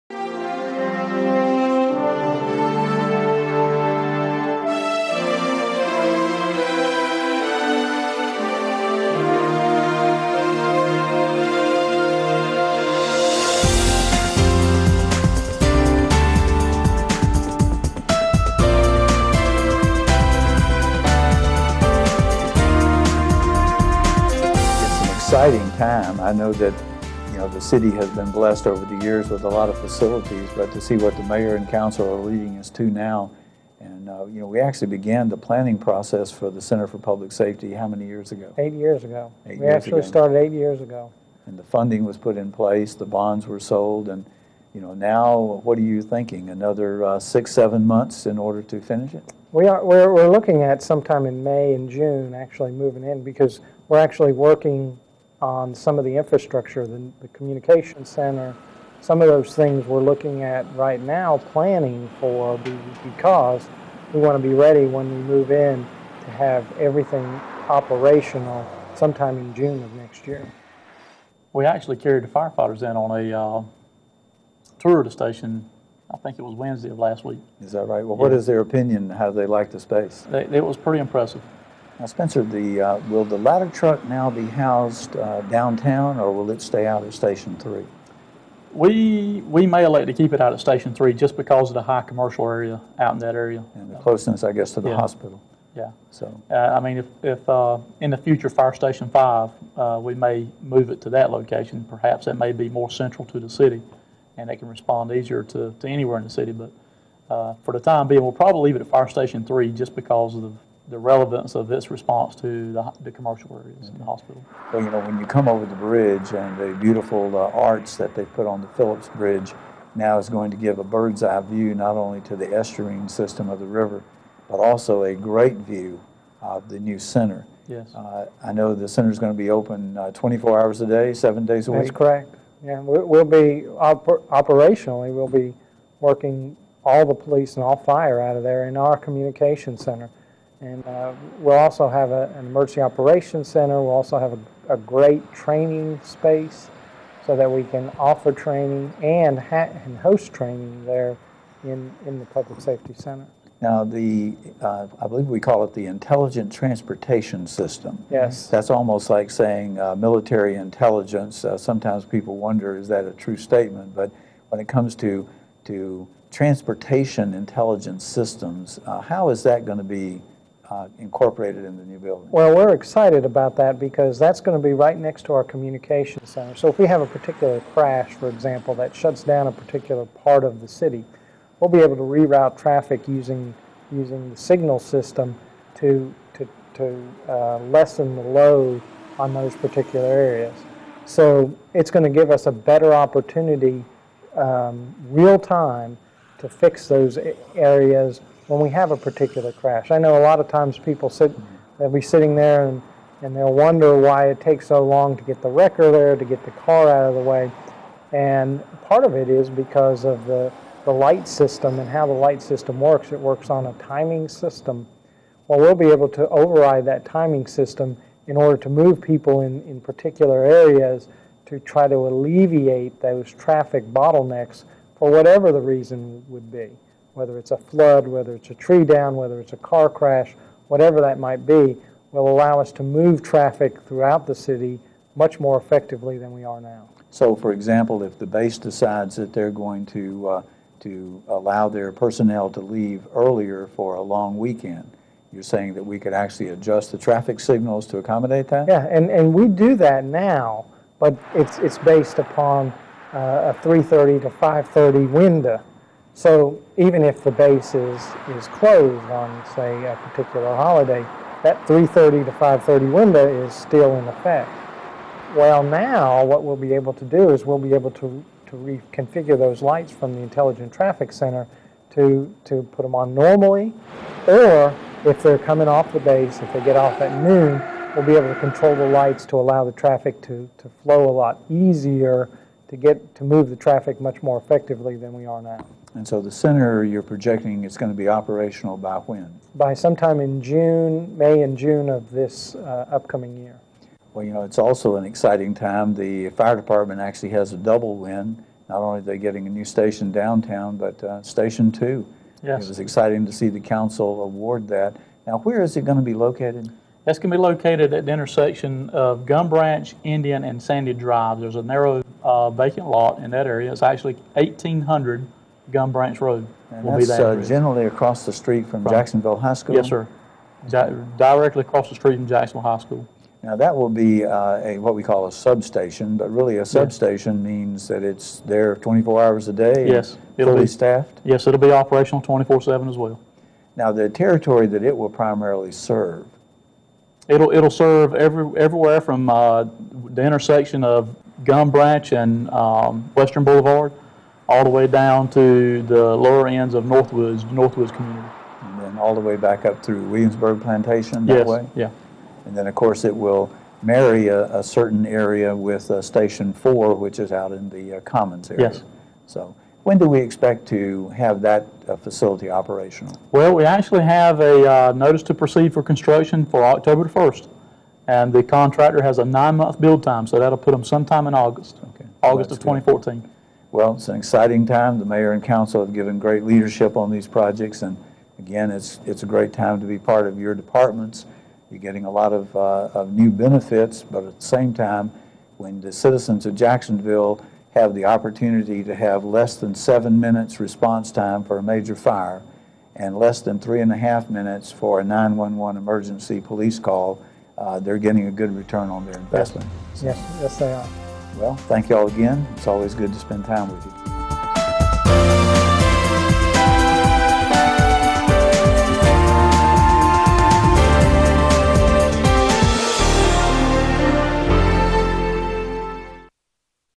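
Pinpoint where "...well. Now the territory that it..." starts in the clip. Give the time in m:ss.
5:32.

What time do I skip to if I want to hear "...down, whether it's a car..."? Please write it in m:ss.
3:48.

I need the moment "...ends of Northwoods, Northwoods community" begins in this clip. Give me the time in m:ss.
5:46.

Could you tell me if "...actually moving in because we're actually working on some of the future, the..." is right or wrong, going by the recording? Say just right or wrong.
wrong.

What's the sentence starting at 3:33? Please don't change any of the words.
It works on a timing system.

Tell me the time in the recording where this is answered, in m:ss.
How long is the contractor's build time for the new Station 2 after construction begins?
6:09.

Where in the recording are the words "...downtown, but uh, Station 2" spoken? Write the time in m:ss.
5:00.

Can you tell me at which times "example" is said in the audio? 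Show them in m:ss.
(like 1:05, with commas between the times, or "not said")
2:58, 3:57.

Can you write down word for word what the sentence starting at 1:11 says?
We actually carried the firefighters in on a uh, tour of the station.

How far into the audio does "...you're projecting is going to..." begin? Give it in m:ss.
4:46.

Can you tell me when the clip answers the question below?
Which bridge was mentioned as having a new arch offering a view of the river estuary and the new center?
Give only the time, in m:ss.
1:58.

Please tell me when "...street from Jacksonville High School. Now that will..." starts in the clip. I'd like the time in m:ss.
5:21.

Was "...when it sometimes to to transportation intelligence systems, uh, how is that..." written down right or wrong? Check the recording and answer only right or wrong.
wrong.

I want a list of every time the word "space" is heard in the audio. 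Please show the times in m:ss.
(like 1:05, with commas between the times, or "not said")
1:19, 2:26.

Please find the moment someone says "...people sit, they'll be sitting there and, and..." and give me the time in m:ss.
3:20.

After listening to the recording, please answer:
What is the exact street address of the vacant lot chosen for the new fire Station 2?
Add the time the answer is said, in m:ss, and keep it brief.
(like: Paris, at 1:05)
1800 Gum Branch Road, at 5:14.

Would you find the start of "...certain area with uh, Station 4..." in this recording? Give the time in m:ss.
5:54.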